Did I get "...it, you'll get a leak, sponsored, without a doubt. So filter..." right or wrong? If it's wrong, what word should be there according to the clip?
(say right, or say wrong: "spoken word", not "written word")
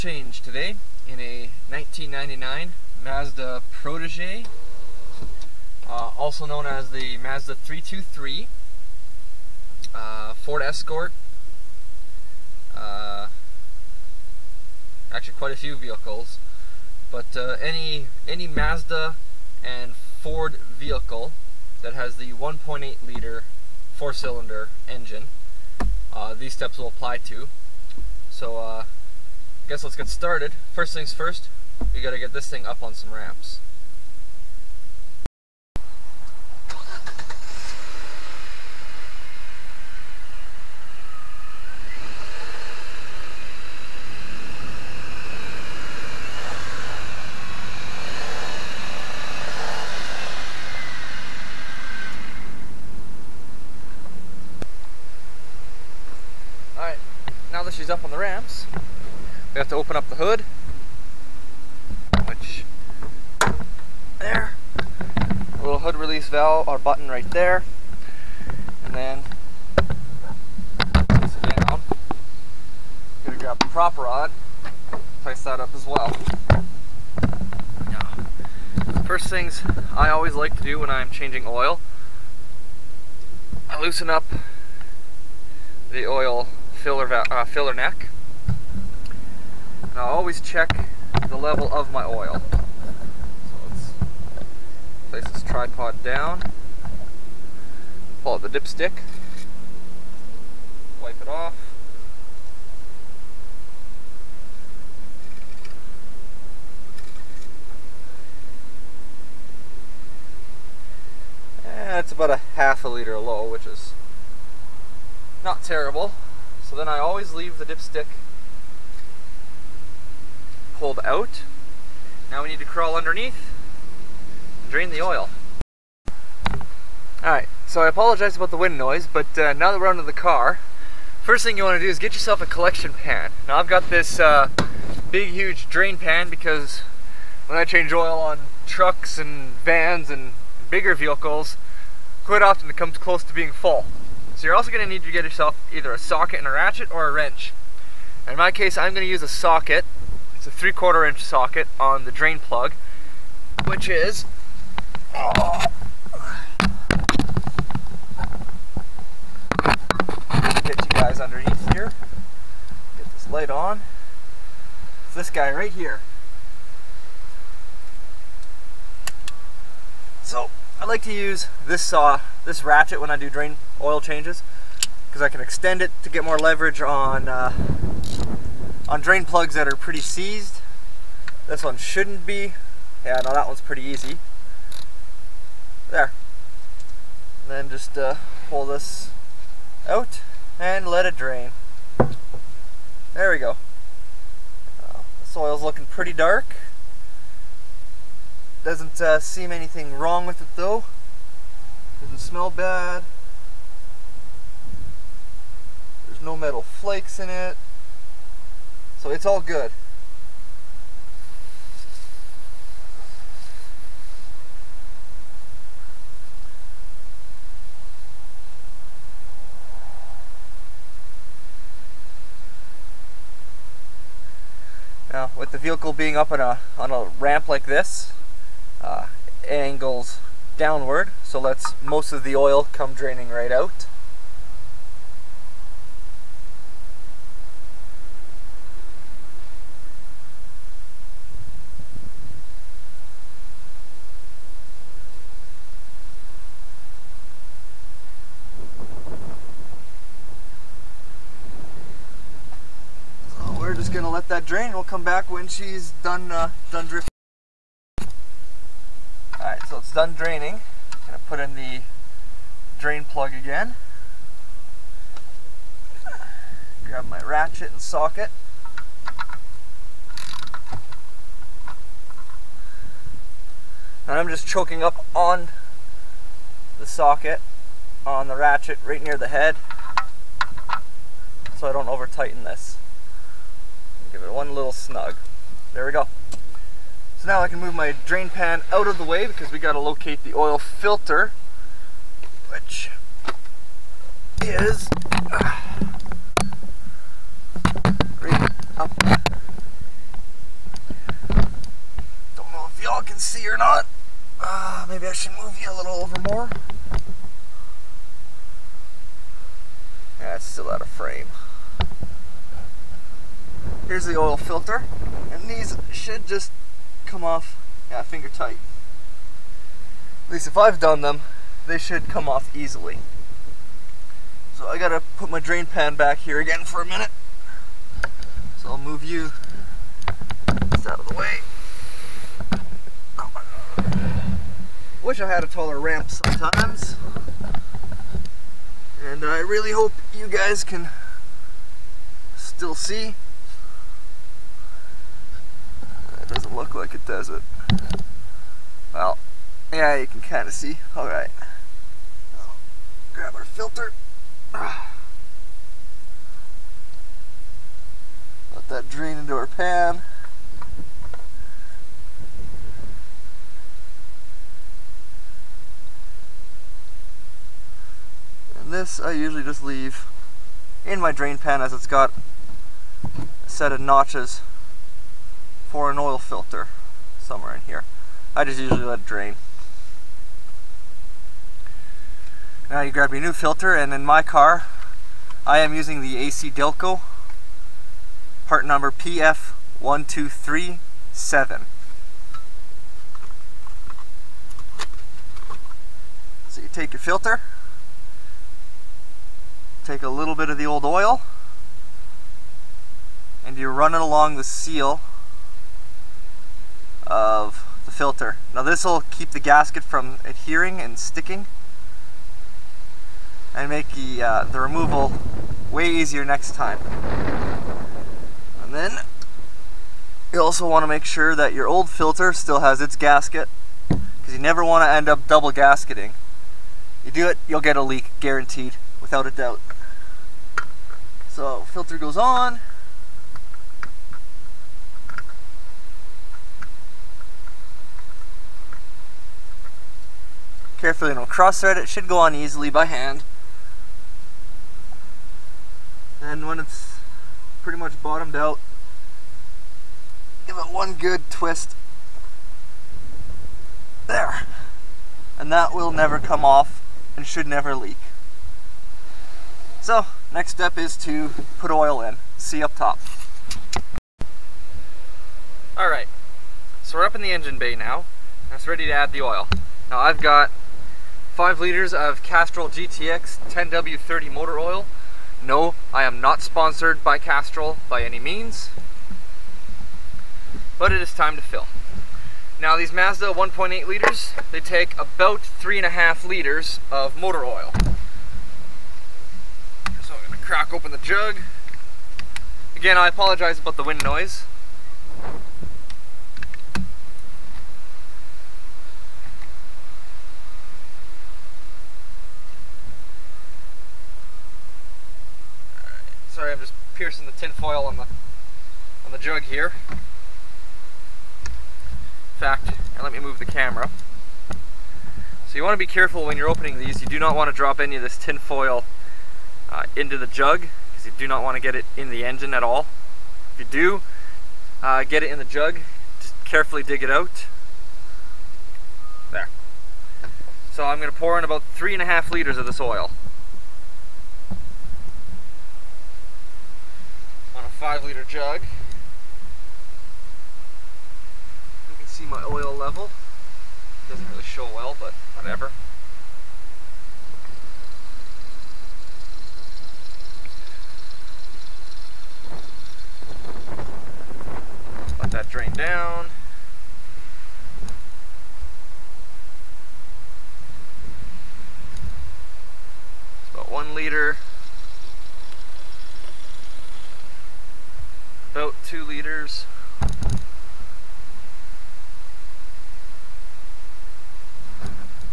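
wrong: "guaranteed", not "sponsored".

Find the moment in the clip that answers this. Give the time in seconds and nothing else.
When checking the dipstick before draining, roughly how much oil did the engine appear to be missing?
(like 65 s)
112 s.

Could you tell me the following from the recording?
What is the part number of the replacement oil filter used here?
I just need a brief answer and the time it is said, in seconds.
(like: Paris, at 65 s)
PF1237, at 388 s.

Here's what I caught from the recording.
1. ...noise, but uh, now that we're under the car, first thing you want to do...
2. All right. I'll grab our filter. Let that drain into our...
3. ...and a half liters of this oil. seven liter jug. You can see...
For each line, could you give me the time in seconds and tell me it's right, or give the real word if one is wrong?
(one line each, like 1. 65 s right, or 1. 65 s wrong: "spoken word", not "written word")
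1. 128 s right
2. 350 s right
3. 531 s wrong: "five", not "seven".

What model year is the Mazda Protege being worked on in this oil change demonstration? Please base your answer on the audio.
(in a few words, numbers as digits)
1999.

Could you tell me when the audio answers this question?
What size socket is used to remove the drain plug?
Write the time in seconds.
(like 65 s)
150 s.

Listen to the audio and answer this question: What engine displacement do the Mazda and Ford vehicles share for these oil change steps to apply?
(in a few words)
1.8 liter.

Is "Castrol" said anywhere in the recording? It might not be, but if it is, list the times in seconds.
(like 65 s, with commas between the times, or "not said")
472 s, 477 s.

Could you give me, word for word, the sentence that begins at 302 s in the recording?
Don't know if y'all can see or not.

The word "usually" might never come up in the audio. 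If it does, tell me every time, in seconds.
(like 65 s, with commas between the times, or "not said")
369 s, 378 s.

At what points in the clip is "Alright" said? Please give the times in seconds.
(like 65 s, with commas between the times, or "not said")
127 s, 465 s.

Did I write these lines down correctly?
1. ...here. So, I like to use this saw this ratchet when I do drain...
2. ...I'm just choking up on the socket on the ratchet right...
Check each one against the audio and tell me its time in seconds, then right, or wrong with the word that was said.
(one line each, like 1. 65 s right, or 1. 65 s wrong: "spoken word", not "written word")
1. 165 s right
2. 274 s right.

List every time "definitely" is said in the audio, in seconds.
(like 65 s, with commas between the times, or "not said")
not said.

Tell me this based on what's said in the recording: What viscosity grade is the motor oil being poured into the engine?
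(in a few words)
10W30.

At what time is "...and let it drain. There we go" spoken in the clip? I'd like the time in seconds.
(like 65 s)
190 s.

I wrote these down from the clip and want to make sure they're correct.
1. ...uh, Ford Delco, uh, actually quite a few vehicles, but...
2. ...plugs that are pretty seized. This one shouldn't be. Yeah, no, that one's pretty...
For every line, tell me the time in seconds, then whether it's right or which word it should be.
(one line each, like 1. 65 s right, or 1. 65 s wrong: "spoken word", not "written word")
1. 9 s wrong: "Escort", not "Delco"
2. 179 s right.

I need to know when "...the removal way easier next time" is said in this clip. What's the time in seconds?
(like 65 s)
414 s.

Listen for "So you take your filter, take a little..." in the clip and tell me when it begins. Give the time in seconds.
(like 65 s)
396 s.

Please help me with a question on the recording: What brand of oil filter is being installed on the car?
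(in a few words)
AC Delco.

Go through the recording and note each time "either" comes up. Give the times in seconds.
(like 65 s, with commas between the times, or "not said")
145 s.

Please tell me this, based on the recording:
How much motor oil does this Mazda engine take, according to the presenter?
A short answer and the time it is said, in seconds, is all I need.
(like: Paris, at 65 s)
3.5 liters, at 485 s.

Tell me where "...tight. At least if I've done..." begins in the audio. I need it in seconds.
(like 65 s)
318 s.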